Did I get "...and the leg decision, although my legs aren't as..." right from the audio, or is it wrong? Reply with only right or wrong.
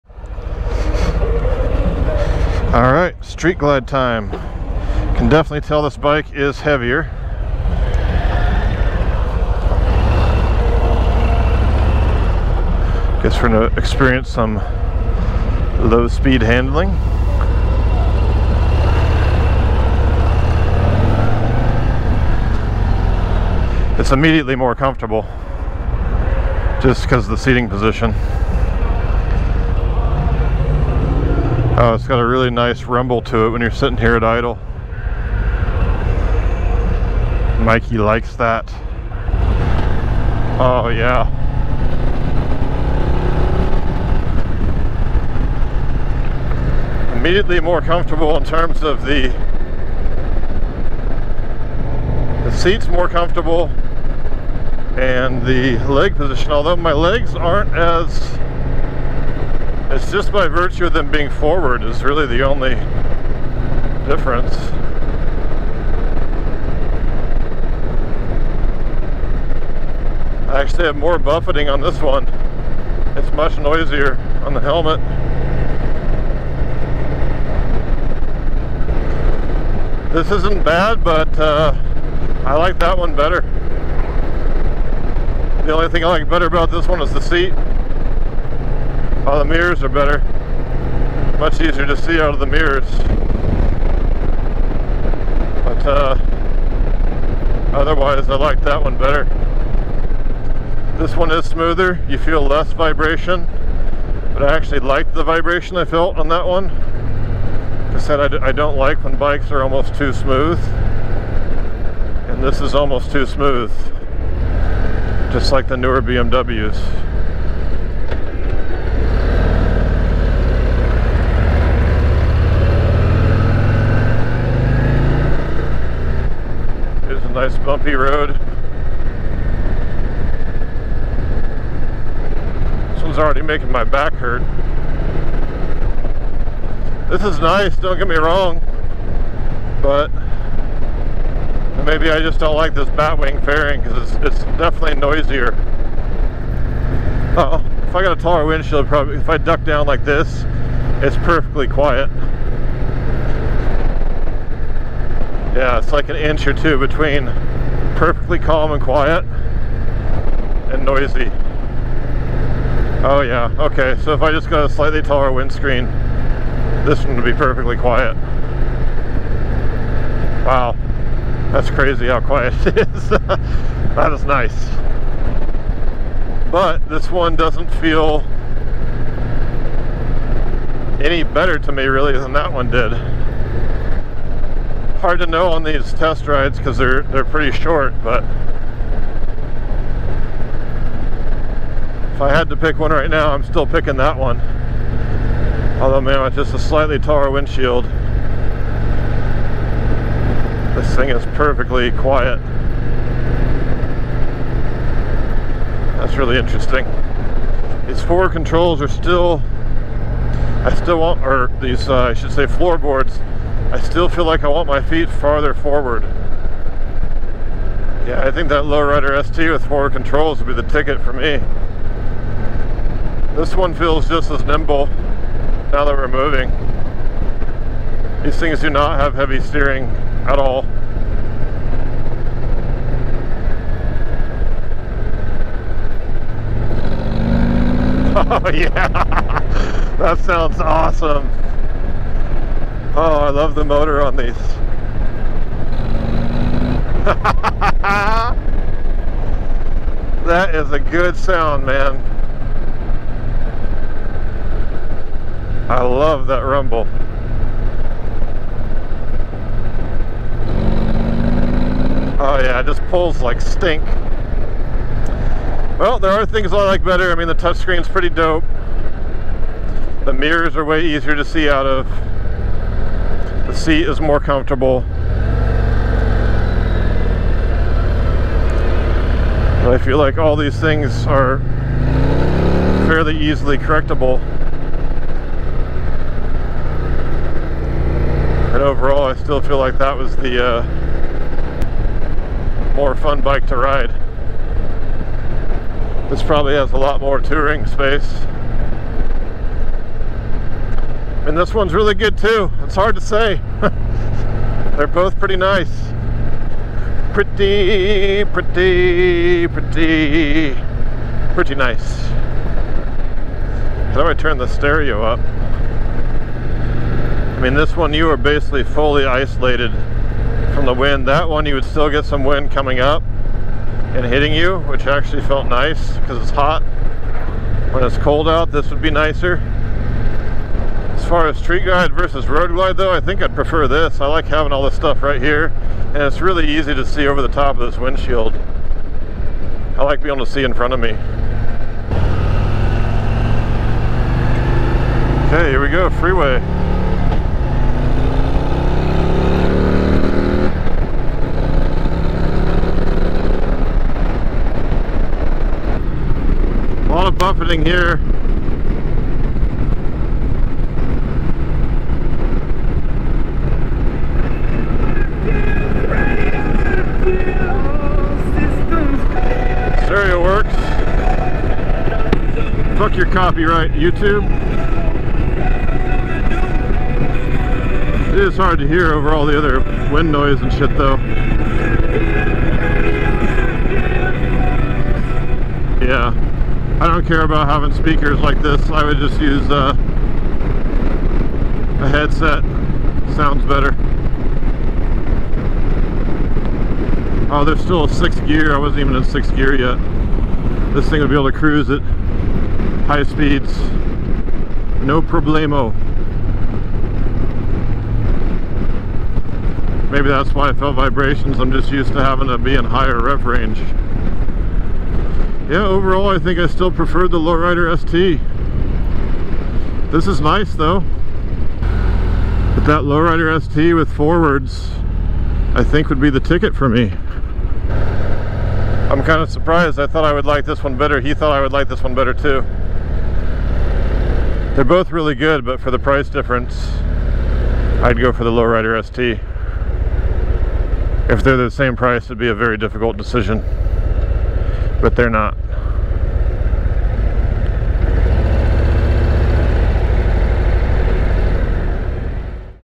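wrong.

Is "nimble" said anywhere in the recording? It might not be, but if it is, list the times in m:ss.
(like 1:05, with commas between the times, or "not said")
3:44.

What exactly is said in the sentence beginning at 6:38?
I wasn't even in sixth gear yet.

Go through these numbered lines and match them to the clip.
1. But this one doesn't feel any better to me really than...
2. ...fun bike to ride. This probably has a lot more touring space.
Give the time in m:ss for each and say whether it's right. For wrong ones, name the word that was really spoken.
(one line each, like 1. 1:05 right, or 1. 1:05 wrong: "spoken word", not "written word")
1. 2:56 right
2. 4:52 right.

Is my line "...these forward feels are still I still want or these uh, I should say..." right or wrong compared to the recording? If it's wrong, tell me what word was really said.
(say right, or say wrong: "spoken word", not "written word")
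wrong: "controls", not "feels".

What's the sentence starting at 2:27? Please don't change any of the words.
Uh oh, if I got a taller windshield, probably if I duck down like this, it's perfectly quiet.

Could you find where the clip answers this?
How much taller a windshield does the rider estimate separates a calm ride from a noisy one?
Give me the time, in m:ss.
2:36.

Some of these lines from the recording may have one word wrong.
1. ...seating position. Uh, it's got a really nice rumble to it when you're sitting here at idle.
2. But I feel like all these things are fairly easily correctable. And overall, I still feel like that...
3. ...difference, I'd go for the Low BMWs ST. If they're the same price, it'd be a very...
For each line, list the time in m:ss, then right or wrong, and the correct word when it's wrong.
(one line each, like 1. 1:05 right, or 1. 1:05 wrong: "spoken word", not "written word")
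1. 0:27 right
2. 4:39 right
3. 7:16 wrong: "Rider", not "BMWs".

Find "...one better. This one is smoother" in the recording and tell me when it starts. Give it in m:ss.
1:38.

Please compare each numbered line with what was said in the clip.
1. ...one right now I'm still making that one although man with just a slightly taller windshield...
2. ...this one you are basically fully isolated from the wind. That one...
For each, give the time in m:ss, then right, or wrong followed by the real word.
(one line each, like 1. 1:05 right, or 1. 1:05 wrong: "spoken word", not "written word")
1. 3:12 wrong: "picking", not "making"
2. 5:17 right.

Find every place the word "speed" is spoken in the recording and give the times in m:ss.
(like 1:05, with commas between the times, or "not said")
0:16, 6:43.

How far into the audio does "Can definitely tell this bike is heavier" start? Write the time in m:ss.
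0:05.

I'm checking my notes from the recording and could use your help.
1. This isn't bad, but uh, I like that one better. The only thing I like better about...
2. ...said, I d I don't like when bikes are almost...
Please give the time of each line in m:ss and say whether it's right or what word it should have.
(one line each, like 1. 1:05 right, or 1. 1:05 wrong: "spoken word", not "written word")
1. 1:20 right
2. 1:47 right.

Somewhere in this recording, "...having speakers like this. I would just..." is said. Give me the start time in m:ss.
6:27.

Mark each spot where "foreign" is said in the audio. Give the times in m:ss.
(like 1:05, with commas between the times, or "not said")
not said.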